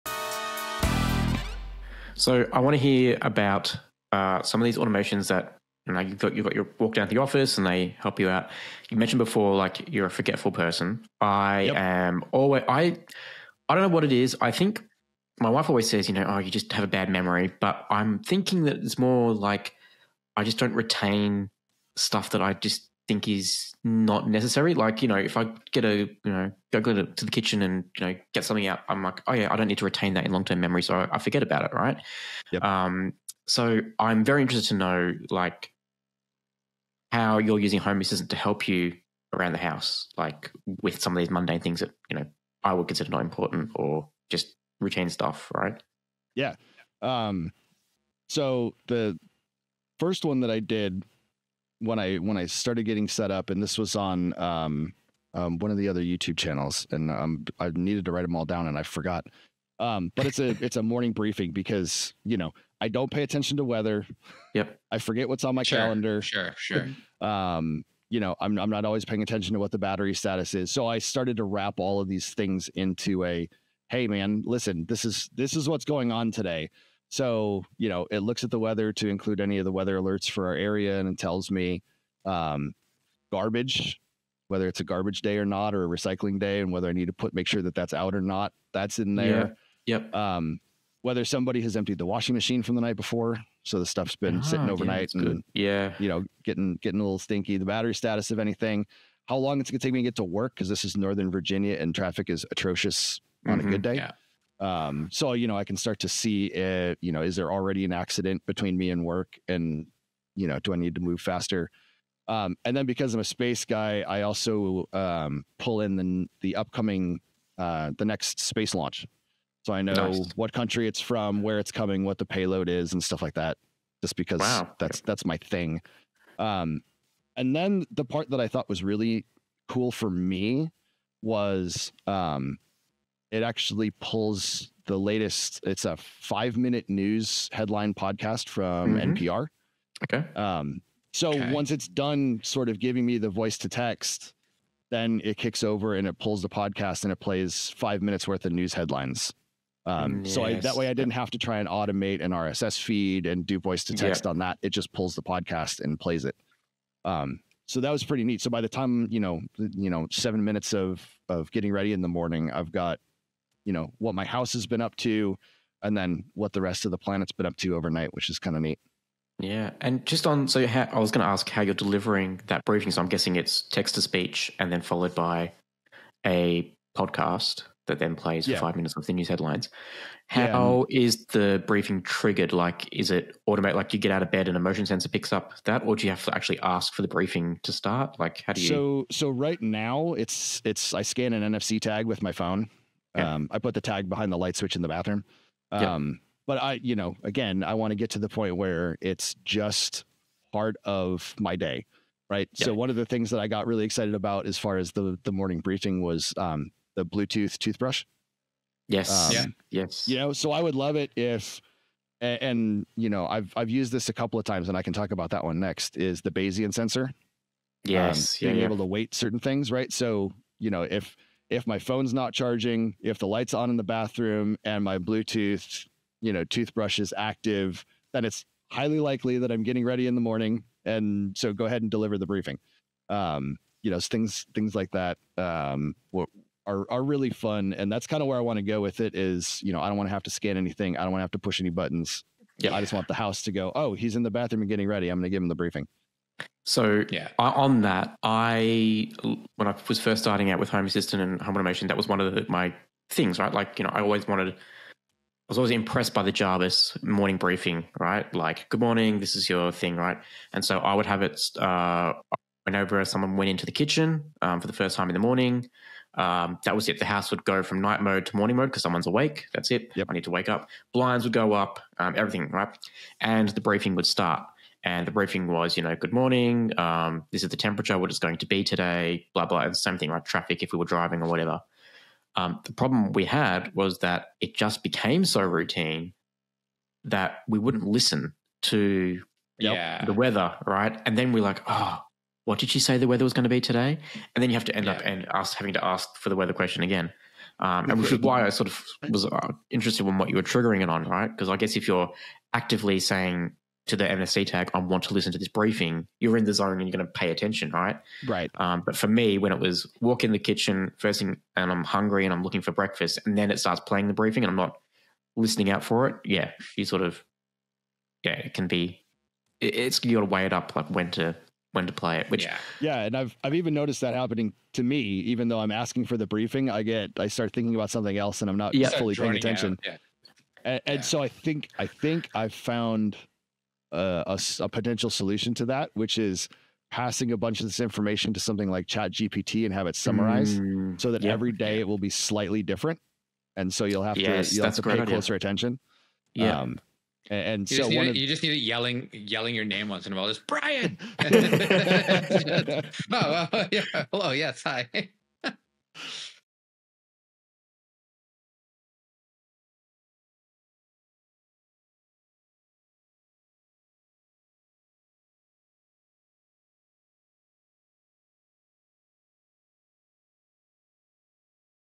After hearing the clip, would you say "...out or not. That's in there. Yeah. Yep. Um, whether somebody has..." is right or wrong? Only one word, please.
right.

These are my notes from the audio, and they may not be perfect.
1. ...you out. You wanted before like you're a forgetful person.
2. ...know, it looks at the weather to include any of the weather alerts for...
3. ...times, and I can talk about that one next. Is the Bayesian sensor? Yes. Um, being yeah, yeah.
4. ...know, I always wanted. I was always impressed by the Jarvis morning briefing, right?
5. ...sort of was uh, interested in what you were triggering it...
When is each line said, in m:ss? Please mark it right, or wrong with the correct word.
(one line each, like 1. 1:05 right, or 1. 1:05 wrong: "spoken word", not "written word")
1. 0:08 wrong: "mentioned", not "wanted"
2. 1:17 right
3. 3:34 right
4. 4:13 right
5. 4:58 right.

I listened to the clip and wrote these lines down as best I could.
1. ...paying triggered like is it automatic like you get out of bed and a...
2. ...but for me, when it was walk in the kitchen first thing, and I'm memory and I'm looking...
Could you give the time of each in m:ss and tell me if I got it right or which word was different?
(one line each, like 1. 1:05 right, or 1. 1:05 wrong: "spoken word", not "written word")
1. 3:01 wrong: "briefing", not "paying"
2. 5:08 wrong: "hungry", not "memory".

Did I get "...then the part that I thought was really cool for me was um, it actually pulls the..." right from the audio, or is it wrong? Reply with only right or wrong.
right.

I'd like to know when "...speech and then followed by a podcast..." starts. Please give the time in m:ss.
2:54.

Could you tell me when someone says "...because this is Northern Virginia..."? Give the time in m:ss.
1:40.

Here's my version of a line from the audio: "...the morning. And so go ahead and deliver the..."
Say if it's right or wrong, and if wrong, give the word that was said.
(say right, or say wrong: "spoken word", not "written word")
right.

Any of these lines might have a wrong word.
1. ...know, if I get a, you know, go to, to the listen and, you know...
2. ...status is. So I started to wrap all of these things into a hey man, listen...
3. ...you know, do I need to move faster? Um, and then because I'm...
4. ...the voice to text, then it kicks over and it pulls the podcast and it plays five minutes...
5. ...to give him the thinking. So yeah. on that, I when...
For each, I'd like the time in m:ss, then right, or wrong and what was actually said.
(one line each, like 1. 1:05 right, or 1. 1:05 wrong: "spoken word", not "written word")
1. 0:25 wrong: "kitchen", not "listen"
2. 1:10 right
3. 1:50 right
4. 2:23 right
5. 4:05 wrong: "briefing", not "thinking".